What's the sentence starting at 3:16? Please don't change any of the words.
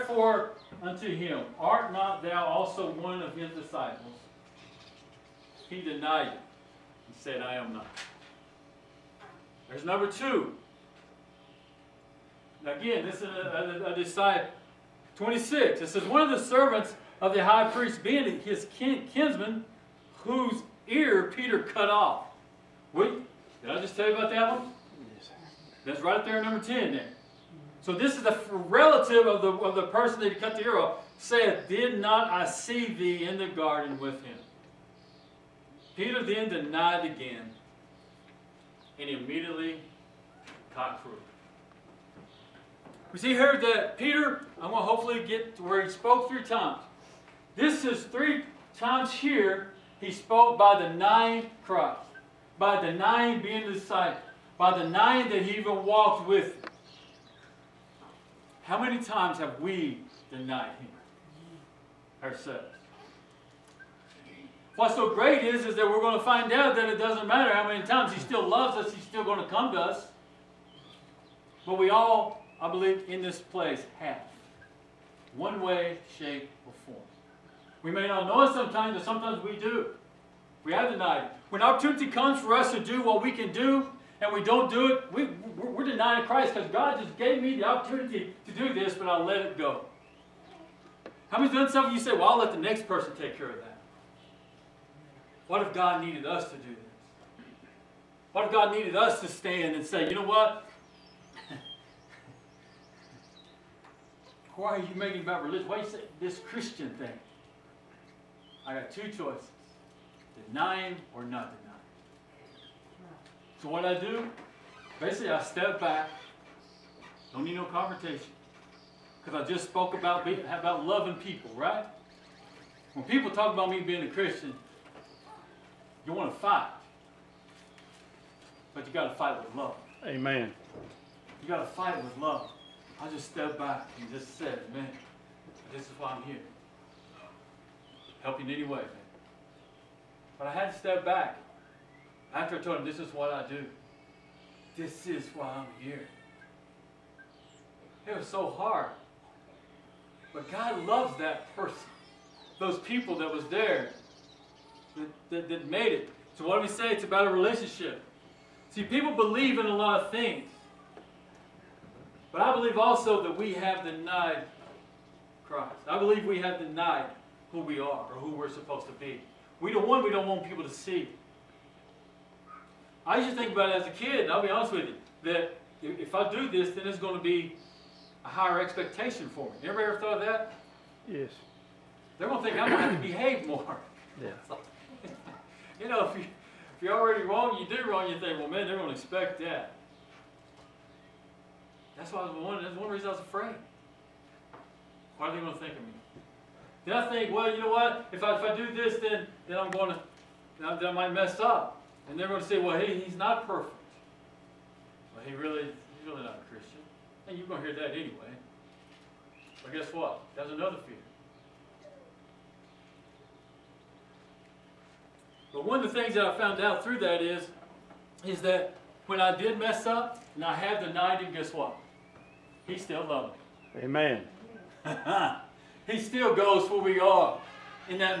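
Then I think, well, you know what?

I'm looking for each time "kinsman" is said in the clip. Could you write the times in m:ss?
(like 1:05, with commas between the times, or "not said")
0:19.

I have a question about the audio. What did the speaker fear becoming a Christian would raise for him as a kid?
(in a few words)
Expectation.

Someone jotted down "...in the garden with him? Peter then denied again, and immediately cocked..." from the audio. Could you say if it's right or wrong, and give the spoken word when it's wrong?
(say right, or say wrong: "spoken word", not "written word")
right.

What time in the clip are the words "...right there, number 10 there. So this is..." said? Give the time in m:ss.
0:26.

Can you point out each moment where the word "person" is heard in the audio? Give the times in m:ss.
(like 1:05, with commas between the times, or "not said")
0:29, 1:32, 2:31.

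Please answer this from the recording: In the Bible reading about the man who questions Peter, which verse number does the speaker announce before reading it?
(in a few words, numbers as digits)
26.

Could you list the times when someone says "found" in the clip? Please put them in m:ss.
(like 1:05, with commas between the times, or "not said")
3:36.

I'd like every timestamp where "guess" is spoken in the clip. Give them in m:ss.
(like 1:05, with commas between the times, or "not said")
3:29, 3:41.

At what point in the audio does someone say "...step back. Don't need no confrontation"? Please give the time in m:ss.
1:55.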